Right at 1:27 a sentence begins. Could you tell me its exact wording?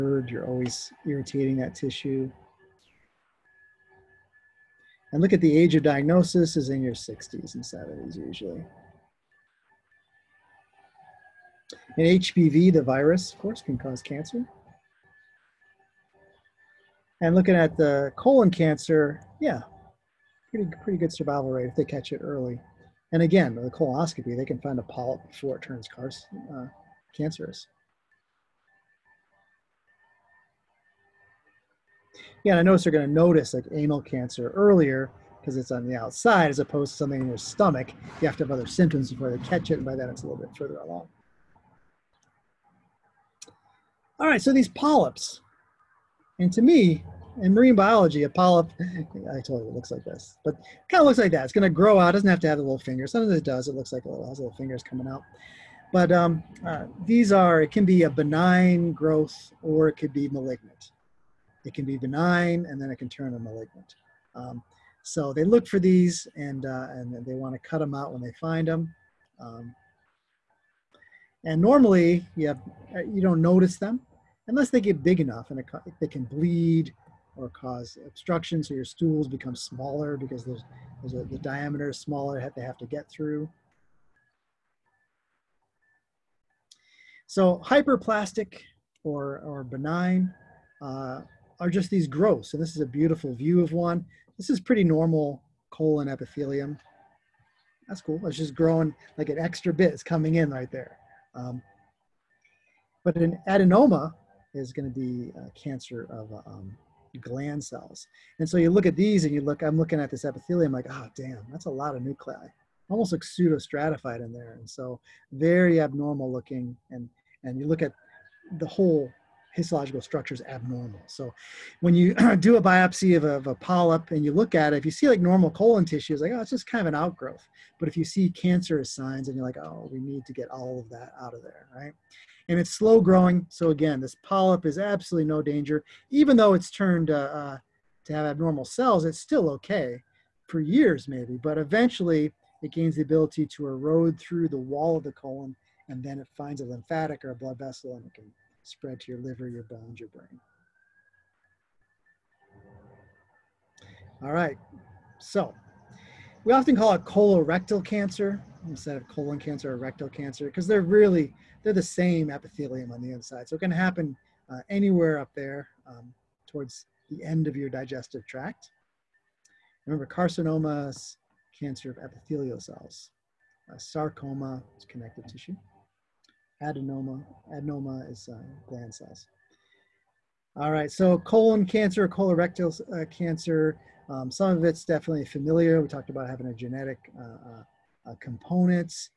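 So hyperplastic or, or benign uh, are just these growths.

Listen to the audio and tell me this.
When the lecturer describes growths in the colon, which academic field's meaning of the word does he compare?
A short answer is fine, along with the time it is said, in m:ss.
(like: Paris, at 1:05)
Marine biology, at 0:47.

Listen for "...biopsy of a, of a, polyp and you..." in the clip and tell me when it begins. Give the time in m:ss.
2:02.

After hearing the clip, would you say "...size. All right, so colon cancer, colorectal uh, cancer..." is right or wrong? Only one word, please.
right.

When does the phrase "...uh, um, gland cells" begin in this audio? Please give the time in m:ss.
1:46.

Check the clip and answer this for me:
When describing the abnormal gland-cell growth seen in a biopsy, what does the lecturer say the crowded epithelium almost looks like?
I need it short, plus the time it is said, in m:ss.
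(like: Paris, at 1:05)
Pseudostratified, at 1:53.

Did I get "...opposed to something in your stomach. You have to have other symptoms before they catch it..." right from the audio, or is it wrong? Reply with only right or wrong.
right.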